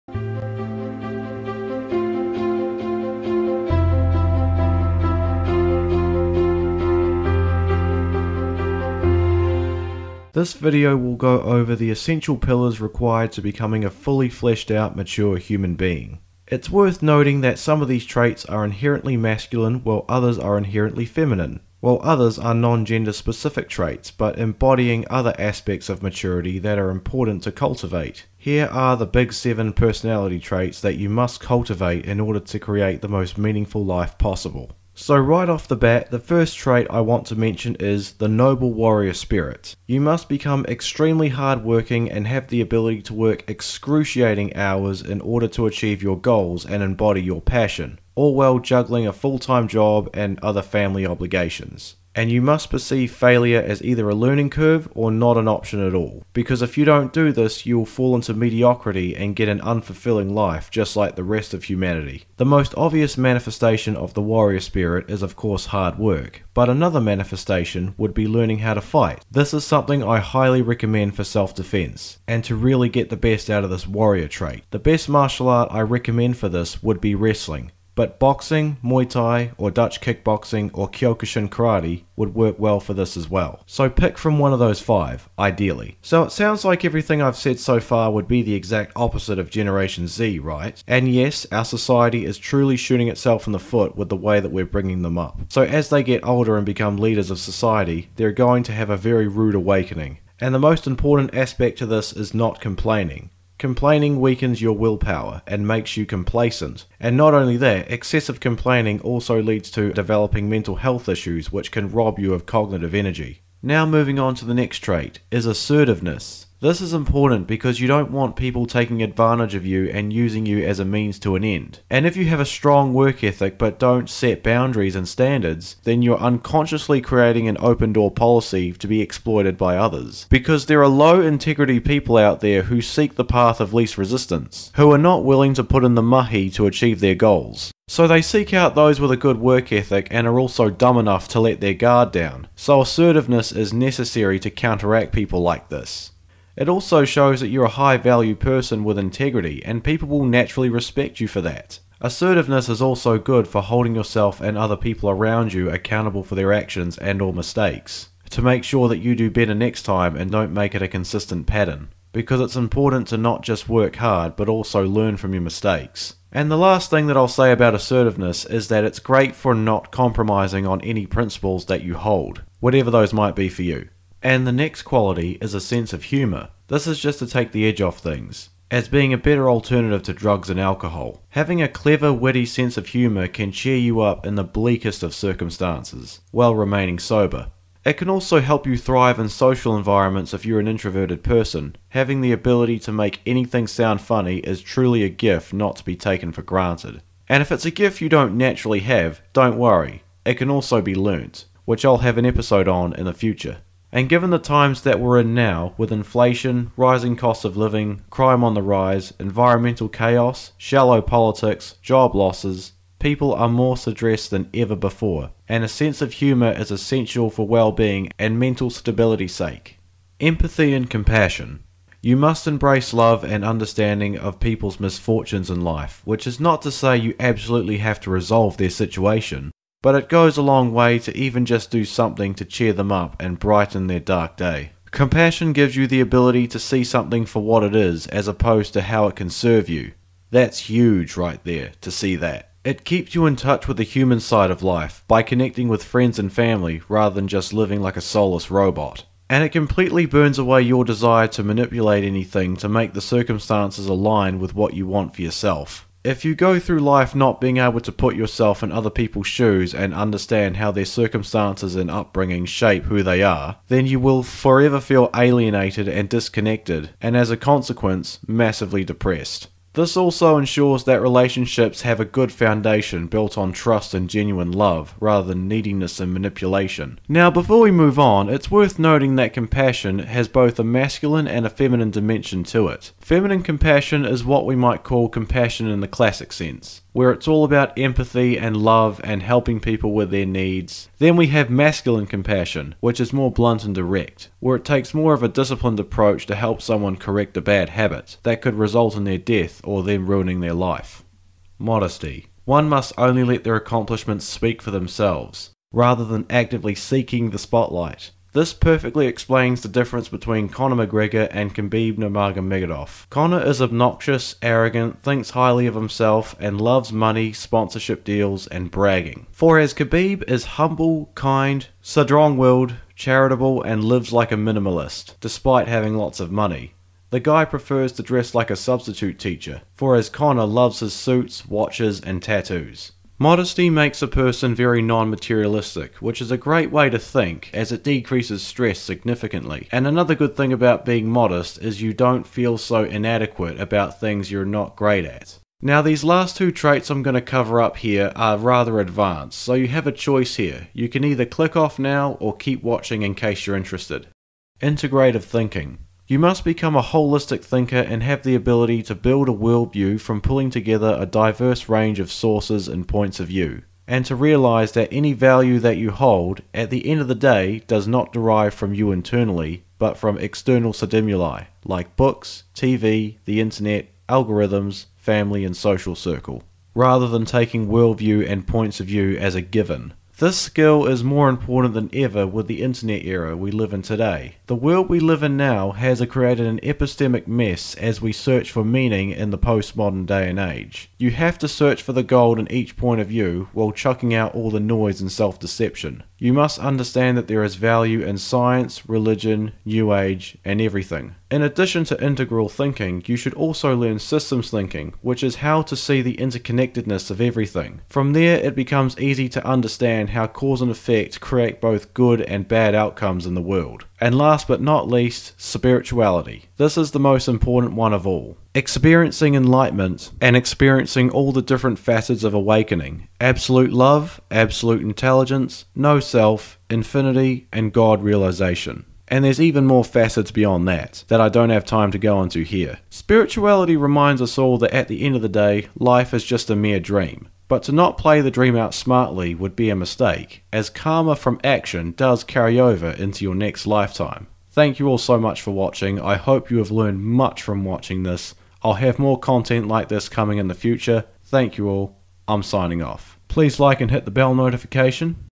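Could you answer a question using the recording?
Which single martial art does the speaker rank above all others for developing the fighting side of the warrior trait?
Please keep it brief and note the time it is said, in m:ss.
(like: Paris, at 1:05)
Wrestling, at 1:17.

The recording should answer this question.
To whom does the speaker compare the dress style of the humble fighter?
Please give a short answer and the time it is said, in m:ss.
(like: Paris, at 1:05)
A substitute teacher, at 5:28.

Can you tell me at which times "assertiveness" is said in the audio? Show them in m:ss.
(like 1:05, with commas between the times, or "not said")
1:55, 2:22, 2:31, 2:47.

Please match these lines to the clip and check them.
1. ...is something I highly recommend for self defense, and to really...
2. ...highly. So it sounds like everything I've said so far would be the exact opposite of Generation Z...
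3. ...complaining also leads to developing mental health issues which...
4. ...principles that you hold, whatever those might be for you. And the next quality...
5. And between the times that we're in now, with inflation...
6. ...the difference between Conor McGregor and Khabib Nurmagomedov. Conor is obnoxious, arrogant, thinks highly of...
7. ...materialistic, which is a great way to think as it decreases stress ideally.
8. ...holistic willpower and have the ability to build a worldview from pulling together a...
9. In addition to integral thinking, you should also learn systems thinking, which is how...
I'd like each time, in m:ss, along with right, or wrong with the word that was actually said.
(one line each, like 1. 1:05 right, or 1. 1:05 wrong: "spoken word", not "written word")
1. 1:09 right
2. 1:25 wrong: "ideally", not "highly"
3. 1:48 right
4. 2:51 right
5. 3:23 wrong: "given", not "between"
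6. 5:09 right
7. 5:35 wrong: "significantly", not "ideally"
8. 5:56 wrong: "thinker", not "willpower"
9. 6:41 right.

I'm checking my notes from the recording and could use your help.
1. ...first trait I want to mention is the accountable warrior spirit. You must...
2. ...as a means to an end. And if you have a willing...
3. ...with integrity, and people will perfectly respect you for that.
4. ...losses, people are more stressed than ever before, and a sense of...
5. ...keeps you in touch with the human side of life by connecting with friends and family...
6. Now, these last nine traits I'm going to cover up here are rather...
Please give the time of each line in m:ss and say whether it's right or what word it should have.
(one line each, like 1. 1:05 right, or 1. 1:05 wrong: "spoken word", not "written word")
1. 0:36 wrong: "noble", not "accountable"
2. 2:00 wrong: "strong", not "willing"
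3. 2:28 wrong: "naturally", not "perfectly"
4. 3:32 right
5. 4:02 right
6. 5:45 wrong: "two", not "nine".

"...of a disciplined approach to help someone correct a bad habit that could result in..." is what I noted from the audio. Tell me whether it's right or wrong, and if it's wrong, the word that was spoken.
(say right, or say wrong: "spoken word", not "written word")
right.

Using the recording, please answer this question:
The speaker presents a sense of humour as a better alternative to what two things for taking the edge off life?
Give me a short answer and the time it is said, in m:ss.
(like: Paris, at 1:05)
Drugs and alcohol, at 3:00.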